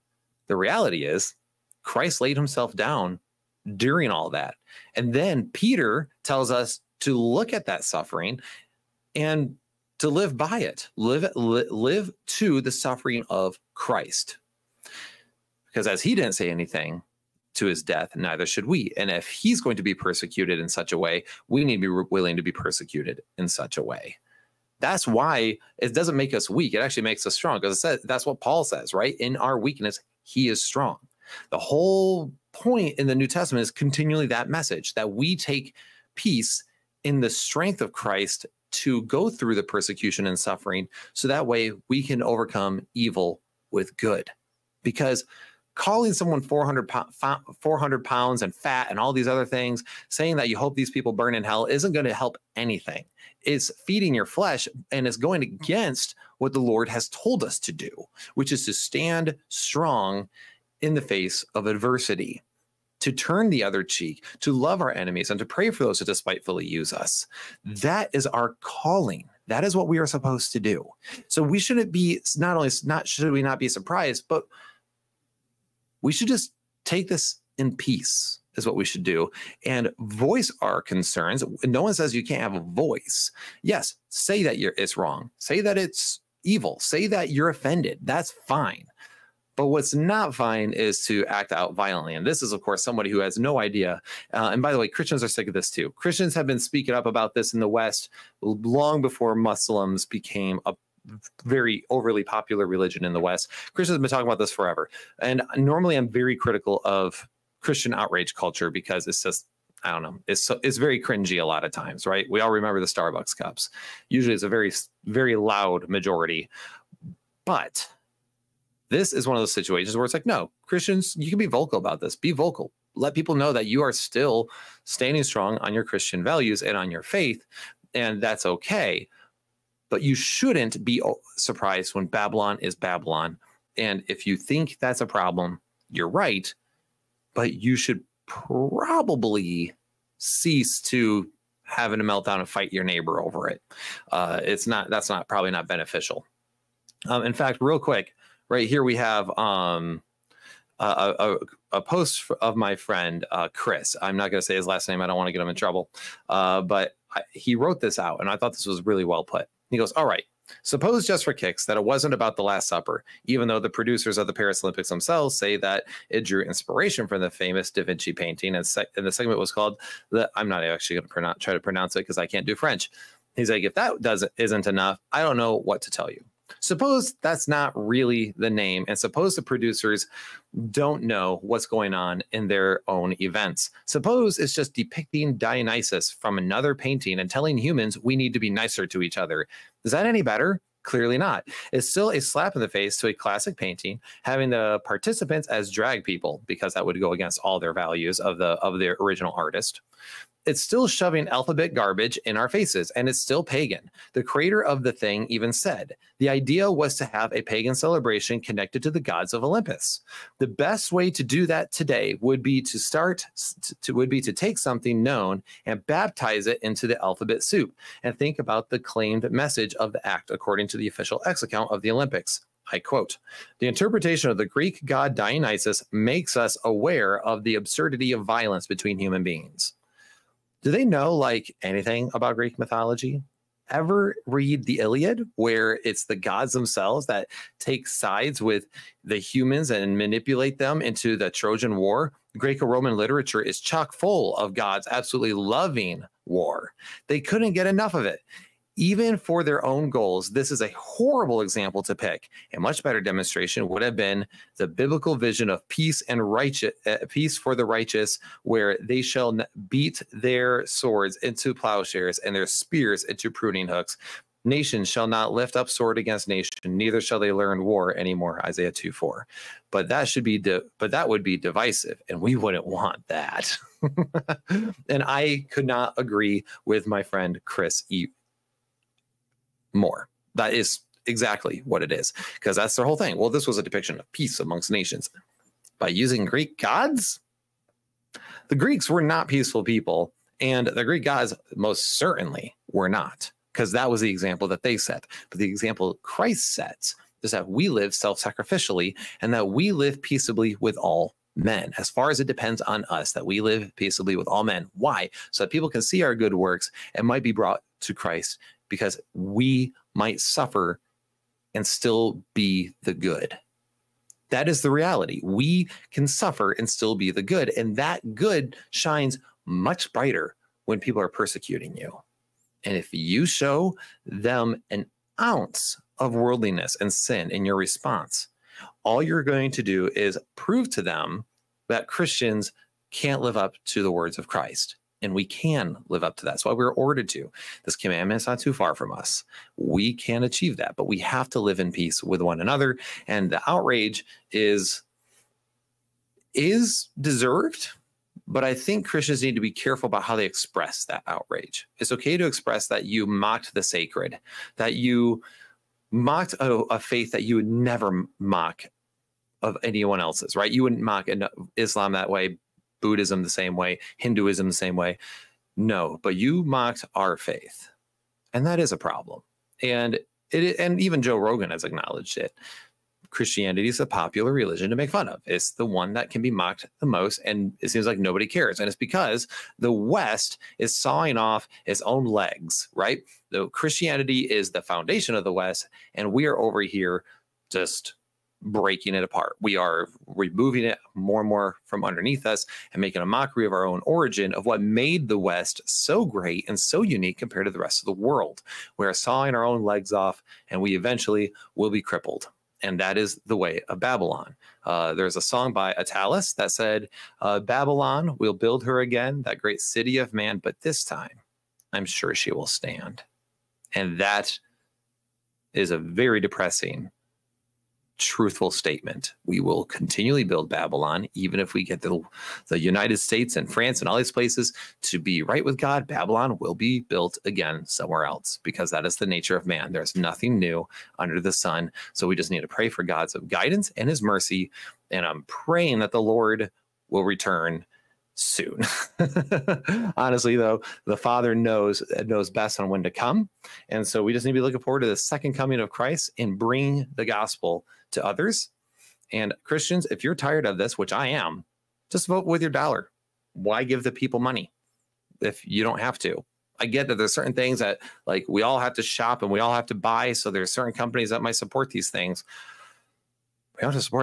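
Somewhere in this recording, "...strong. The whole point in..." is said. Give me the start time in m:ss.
0:30.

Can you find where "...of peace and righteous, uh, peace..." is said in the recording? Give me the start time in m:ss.
4:15.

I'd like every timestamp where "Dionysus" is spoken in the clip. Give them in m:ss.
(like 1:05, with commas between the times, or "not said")
3:05, 3:45.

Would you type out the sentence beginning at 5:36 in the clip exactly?
That's why we are ordered to.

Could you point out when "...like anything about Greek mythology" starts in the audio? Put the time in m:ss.
3:51.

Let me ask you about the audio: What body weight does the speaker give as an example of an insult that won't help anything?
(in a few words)
400 pounds.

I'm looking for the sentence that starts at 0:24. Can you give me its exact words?
That's why it doesn't make us weak.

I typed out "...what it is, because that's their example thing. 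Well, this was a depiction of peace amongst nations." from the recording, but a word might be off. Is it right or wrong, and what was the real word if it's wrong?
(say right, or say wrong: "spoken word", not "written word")
wrong: "whole", not "example".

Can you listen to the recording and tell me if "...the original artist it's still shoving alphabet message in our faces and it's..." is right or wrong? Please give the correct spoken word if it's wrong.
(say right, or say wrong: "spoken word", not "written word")
wrong: "garbage", not "message".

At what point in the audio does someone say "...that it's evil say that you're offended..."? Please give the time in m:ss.
1:25.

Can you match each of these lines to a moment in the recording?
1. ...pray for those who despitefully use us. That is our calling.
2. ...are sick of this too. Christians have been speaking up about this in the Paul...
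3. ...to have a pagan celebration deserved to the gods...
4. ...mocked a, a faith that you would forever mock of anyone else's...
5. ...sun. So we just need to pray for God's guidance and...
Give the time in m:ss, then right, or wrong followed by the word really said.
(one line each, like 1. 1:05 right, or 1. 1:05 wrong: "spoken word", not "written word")
1. 1:05 right
2. 1:35 wrong: "West", not "Paul"
3. 3:26 wrong: "connected", not "deserved"
4. 5:55 wrong: "never", not "forever"
5. 7:11 right.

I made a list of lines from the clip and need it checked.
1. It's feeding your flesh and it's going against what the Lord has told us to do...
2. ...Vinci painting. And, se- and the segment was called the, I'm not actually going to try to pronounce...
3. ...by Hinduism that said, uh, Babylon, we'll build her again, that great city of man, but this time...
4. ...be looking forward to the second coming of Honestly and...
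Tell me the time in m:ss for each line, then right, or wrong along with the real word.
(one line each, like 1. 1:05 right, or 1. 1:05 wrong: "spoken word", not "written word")
1. 0:53 right
2. 2:47 right
3. 6:45 wrong: "Attalus", not "Hinduism"
4. 7:24 wrong: "Christ", not "Honestly".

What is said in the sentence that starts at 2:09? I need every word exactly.
But you shouldn't be uh, surprised when Babylon is Babylon.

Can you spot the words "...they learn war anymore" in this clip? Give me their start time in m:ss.
4:27.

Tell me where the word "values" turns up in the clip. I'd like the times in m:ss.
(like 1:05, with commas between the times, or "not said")
2:06, 3:17.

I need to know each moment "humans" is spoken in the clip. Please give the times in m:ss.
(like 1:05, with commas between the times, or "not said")
3:07, 3:48, 3:59.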